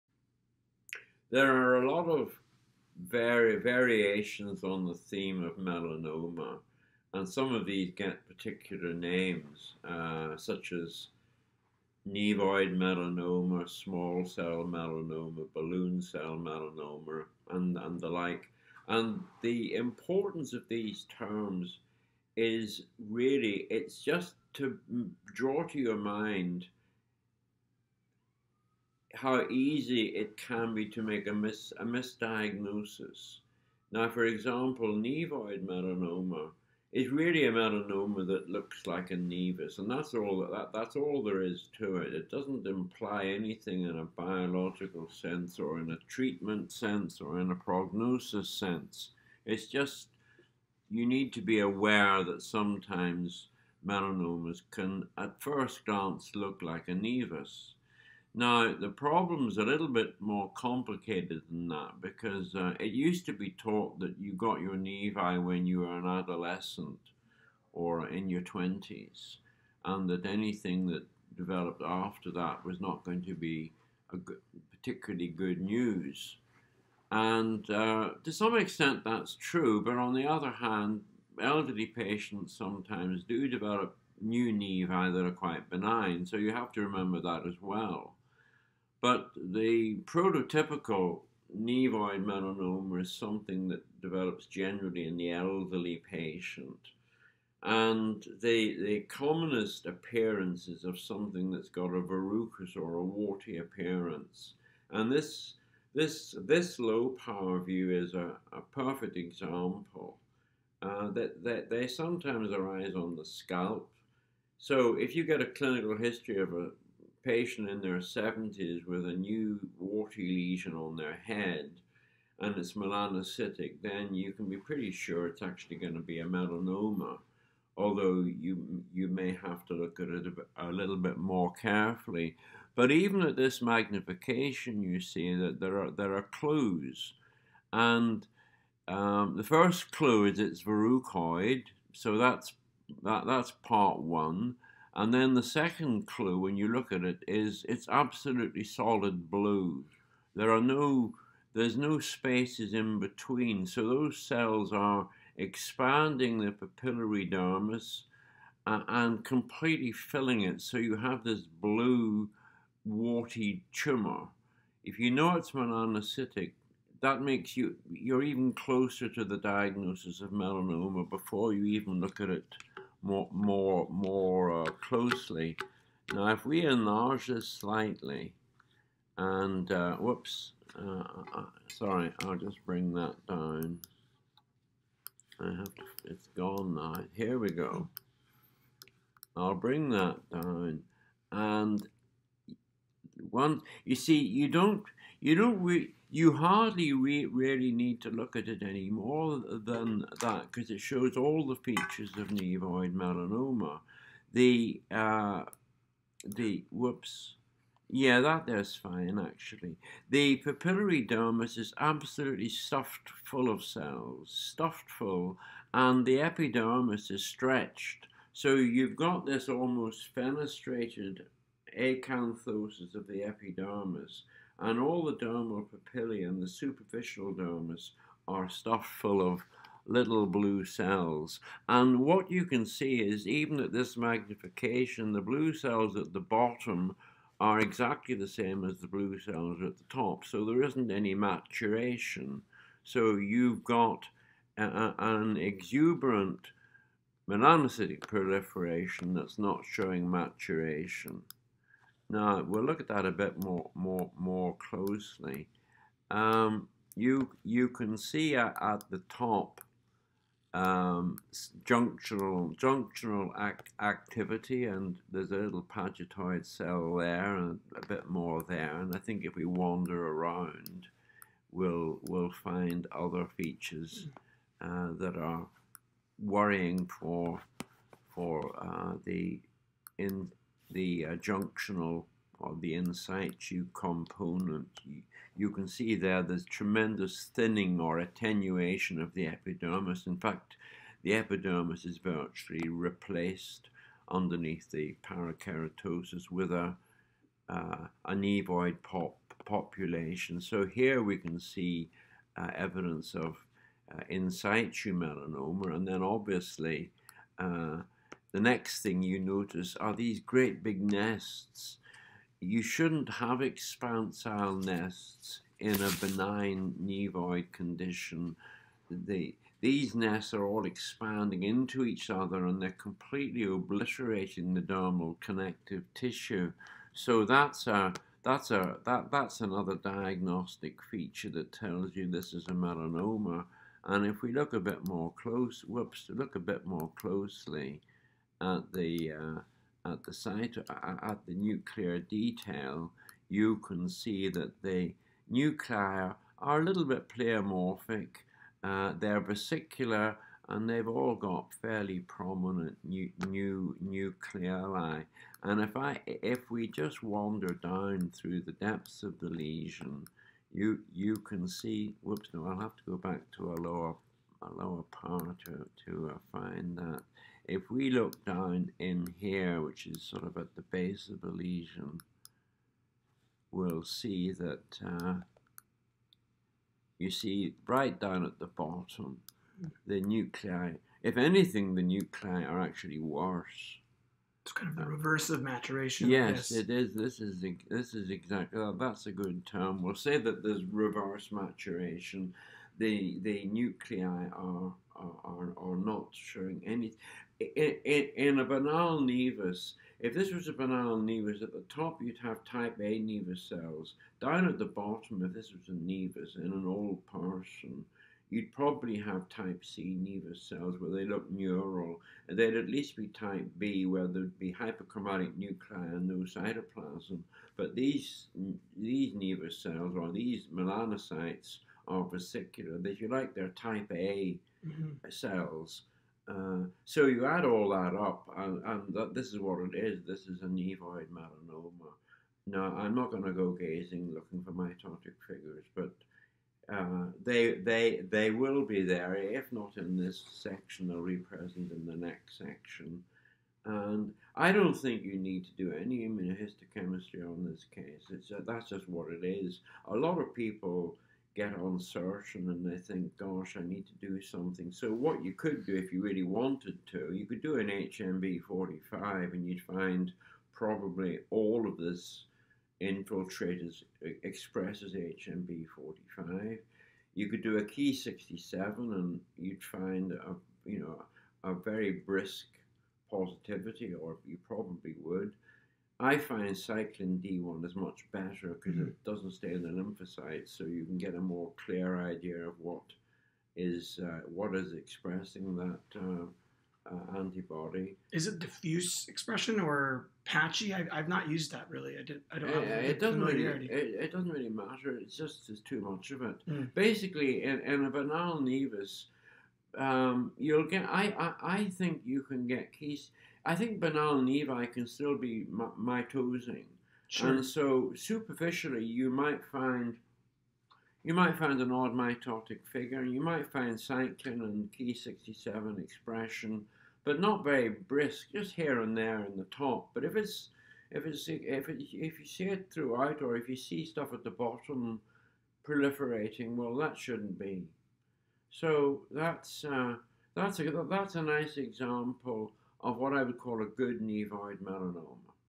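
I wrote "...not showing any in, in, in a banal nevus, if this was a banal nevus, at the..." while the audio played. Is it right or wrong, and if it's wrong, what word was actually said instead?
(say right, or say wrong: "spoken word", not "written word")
right.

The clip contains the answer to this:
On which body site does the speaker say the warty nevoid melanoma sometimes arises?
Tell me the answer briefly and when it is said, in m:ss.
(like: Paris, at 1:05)
scalp, at 1:53.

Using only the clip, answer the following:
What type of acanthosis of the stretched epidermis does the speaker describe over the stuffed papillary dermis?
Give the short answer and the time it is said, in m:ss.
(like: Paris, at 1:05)
fenestrated acanthosis, at 3:40.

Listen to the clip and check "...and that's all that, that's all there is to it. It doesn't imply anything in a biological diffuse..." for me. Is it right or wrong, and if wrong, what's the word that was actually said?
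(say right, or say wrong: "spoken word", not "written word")
wrong: "sense", not "diffuse".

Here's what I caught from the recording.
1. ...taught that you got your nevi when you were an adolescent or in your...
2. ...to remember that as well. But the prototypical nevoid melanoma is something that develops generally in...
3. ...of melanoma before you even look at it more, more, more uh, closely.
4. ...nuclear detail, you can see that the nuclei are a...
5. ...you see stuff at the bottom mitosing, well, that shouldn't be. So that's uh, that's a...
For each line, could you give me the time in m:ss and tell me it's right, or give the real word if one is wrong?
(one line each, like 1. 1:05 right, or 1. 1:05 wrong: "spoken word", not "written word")
1. 1:03 right
2. 1:26 right
3. 2:50 right
4. 5:41 right
5. 8:43 wrong: "proliferating", not "mitosing".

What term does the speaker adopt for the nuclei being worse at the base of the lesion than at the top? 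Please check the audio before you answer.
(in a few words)
reverse maturation.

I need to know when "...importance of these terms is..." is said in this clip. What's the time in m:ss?
0:19.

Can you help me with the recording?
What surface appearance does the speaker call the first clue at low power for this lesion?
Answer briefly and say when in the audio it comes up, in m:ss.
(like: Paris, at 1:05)
verrucoid, at 2:20.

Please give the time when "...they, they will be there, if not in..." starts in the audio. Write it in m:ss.
7:17.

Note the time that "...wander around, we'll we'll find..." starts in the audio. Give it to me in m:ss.
4:29.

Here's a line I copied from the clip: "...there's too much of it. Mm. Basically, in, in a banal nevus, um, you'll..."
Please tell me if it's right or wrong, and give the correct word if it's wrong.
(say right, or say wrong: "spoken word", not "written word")
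right.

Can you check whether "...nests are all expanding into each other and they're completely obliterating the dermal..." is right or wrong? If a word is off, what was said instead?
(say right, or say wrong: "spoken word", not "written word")
right.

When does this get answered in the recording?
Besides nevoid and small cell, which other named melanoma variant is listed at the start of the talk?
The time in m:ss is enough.
0:15.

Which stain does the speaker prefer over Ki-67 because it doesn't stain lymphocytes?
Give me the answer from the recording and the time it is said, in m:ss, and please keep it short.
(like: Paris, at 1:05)
cyclin D1, at 7:56.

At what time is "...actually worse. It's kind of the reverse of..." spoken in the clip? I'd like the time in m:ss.
6:22.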